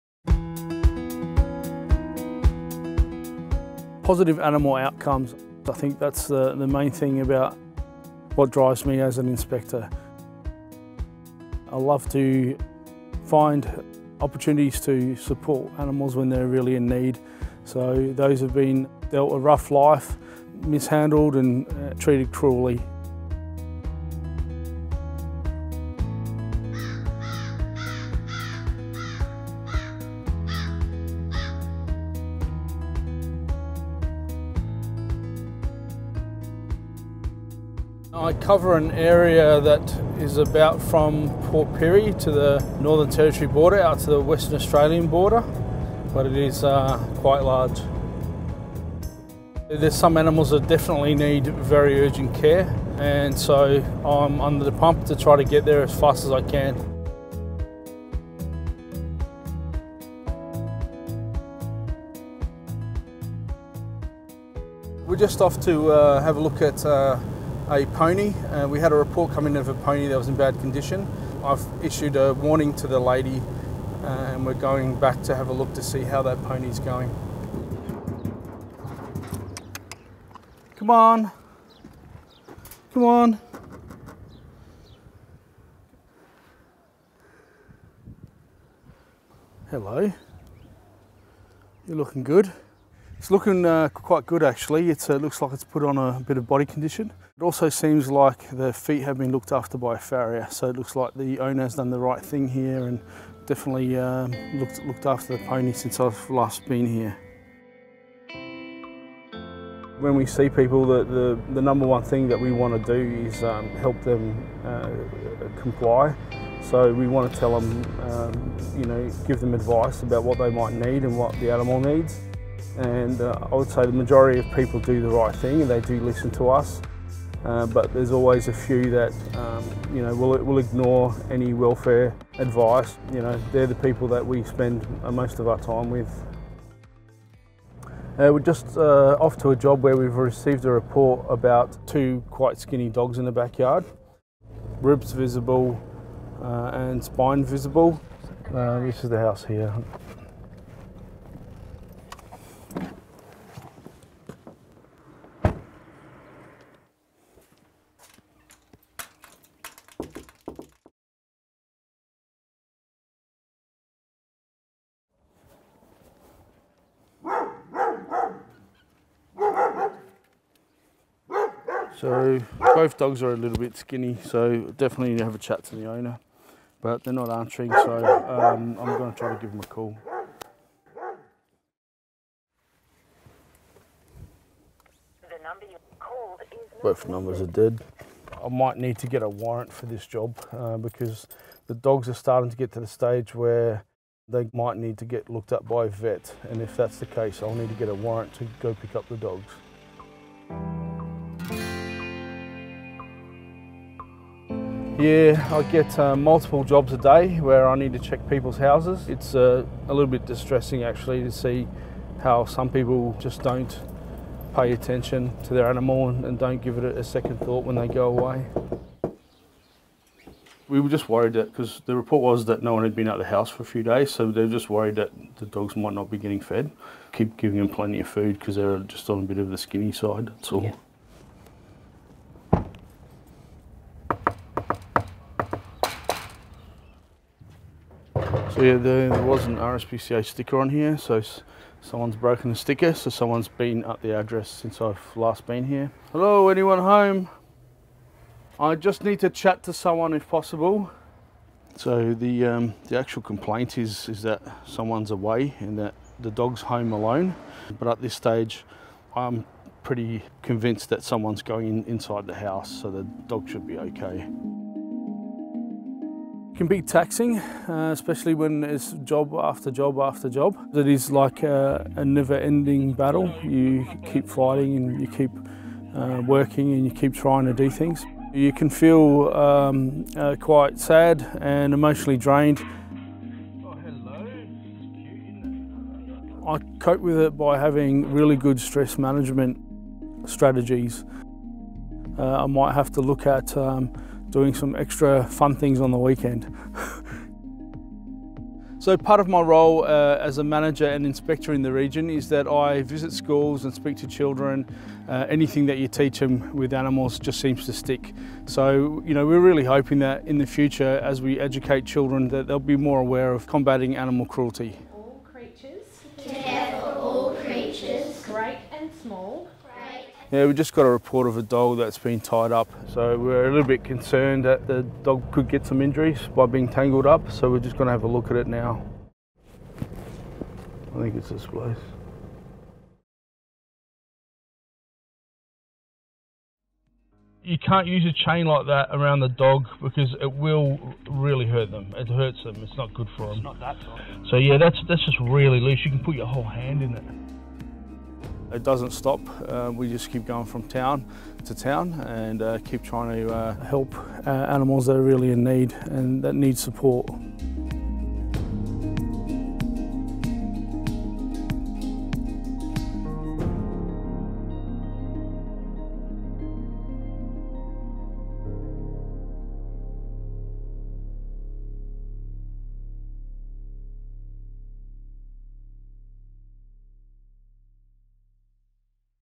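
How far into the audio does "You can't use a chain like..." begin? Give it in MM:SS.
05:37.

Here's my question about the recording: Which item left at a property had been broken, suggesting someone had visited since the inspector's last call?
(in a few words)
RSPCA sticker.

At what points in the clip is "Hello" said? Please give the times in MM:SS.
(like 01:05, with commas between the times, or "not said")
01:29, 04:06.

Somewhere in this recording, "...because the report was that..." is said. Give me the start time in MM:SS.
03:41.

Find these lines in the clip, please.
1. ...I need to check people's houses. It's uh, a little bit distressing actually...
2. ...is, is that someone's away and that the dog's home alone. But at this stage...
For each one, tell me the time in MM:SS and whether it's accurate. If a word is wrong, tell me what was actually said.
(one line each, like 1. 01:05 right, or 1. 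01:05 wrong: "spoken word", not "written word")
1. 03:27 right
2. 04:13 right.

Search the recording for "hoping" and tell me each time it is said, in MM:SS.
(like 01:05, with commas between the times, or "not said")
05:09.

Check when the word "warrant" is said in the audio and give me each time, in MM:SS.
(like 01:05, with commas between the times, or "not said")
03:09, 03:17.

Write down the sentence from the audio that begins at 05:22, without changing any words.
So we're a little bit concerned that the dog could get some injuries by being tangled up.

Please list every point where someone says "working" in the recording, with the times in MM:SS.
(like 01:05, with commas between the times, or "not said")
04:36.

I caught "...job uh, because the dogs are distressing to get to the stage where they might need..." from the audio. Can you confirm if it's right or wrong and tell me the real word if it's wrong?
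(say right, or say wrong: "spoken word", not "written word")
wrong: "starting", not "distressing".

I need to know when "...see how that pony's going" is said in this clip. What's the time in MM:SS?
01:15.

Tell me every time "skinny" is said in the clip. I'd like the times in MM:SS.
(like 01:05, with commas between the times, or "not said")
02:22, 02:53, 03:49.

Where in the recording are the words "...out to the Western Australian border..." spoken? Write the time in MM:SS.
00:43.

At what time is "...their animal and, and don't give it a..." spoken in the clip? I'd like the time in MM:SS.
03:35.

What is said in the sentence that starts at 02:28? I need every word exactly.
Uh, this is the house here.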